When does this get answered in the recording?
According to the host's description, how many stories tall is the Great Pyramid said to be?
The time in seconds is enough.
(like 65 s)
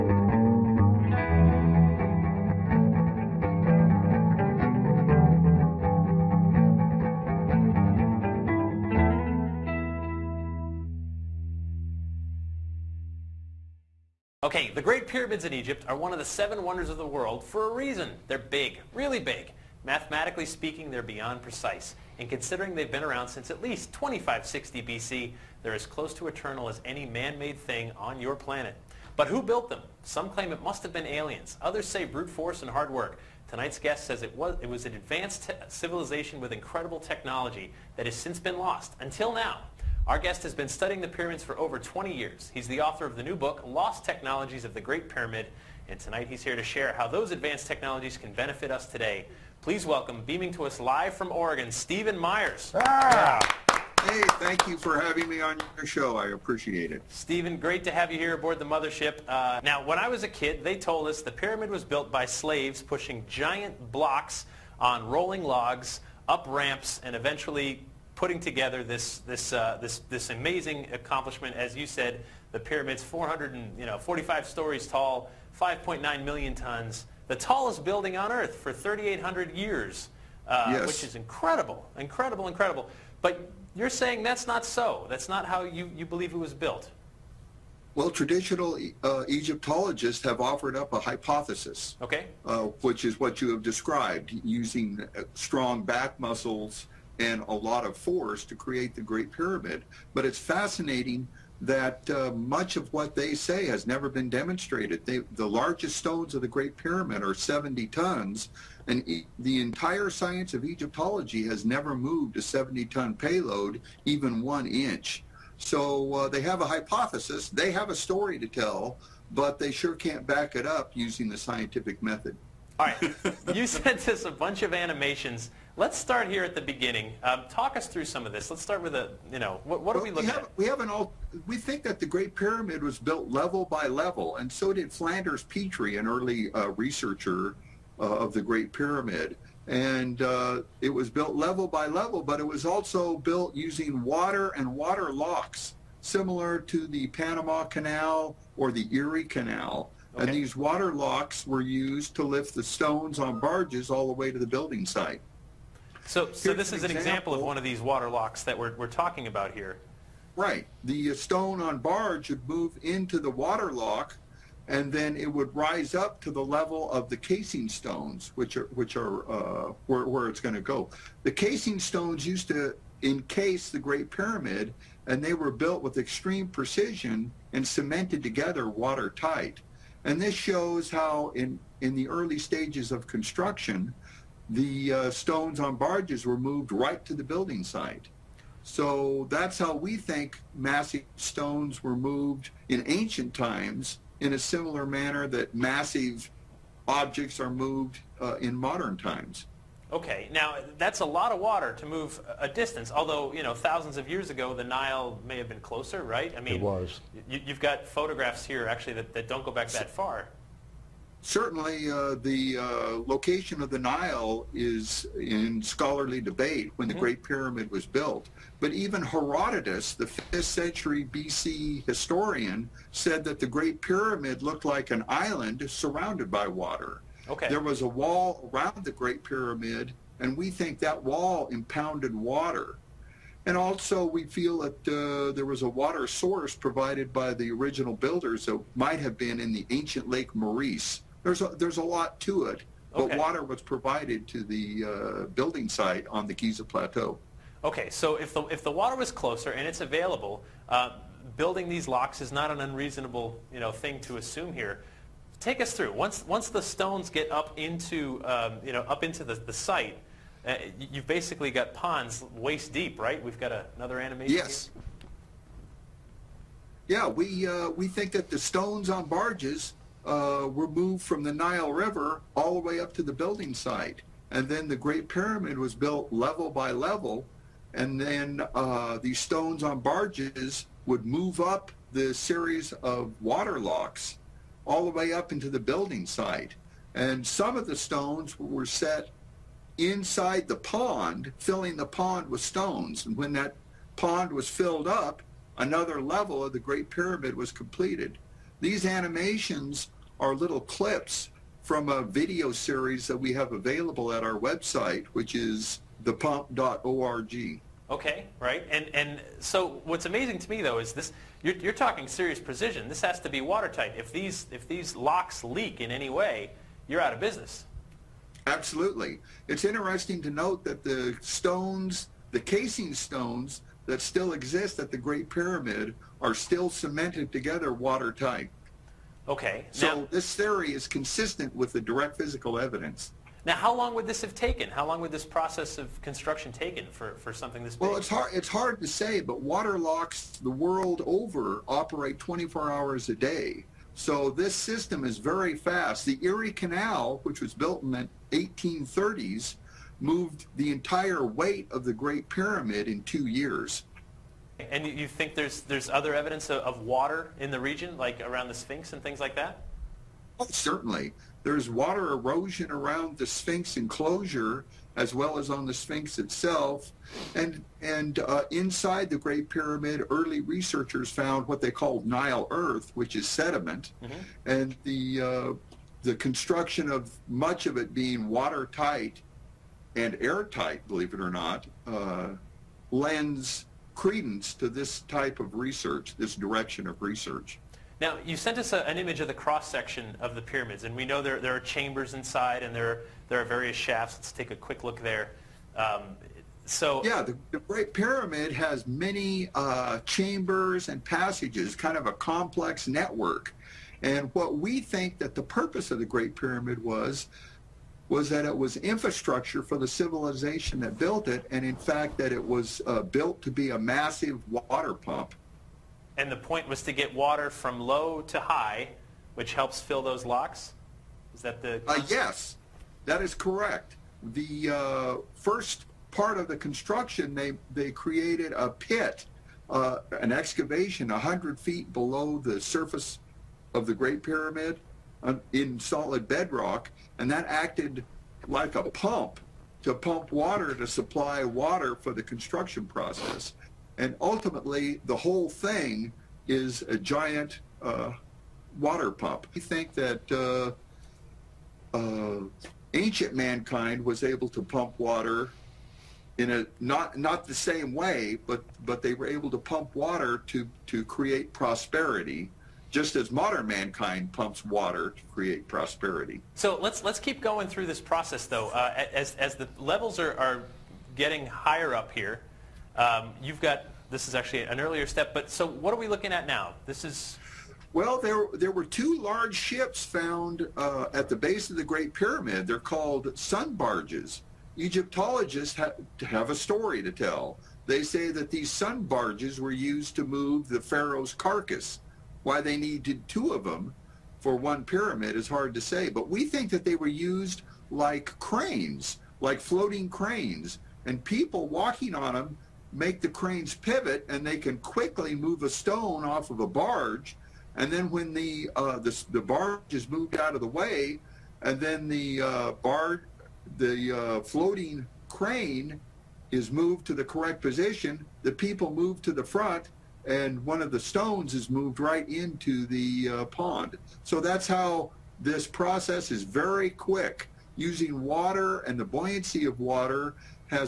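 73 s.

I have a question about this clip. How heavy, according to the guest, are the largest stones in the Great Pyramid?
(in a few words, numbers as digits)
70 tons.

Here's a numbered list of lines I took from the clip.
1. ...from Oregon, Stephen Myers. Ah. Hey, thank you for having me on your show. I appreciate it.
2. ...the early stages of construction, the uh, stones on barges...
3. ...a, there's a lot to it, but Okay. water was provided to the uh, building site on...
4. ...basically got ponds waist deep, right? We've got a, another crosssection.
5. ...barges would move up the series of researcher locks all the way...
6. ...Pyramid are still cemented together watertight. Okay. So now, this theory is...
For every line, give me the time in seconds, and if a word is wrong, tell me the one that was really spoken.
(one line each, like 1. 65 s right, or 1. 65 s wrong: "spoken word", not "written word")
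1. 51 s right
2. 181 s right
3. 241 s right
4. 261 s wrong: "animation", not "crosssection"
5. 279 s wrong: "water", not "researcher"
6. 325 s right.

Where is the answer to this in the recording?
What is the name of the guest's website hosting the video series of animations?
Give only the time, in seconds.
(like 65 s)
306 s.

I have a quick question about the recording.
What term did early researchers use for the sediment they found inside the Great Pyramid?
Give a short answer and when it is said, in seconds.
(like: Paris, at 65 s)
Nile earth, at 372 s.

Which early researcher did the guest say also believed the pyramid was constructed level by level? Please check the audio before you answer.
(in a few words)
Flinders Petrie.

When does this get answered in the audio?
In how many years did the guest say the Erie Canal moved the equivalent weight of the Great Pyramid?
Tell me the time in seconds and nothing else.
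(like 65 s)
353 s.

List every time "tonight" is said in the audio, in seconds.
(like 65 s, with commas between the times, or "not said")
33 s, 45 s.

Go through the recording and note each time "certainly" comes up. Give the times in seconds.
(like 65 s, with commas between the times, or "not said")
211 s, 360 s.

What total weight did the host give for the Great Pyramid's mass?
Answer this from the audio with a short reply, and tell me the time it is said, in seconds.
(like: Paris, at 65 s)
5.9 million tons, at 75 s.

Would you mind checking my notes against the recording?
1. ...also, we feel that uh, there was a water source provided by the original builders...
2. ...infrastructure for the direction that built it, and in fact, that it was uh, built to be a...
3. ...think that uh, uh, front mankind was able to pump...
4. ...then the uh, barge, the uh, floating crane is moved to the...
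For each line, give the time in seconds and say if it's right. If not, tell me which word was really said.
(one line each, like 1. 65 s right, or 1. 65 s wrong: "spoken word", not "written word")
1. 233 s right
2. 408 s wrong: "civilization", not "direction"
3. 449 s wrong: "ancient", not "front"
4. 511 s right.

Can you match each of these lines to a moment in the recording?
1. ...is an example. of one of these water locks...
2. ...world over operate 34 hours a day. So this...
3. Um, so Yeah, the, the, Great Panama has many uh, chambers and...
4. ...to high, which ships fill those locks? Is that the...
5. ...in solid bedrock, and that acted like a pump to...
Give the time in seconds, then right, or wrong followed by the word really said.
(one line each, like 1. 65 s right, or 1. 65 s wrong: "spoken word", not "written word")
1. 156 s right
2. 340 s wrong: "24", not "34"
3. 395 s wrong: "Pyramid", not "Panama"
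4. 418 s wrong: "helps", not "ships"
5. 435 s right.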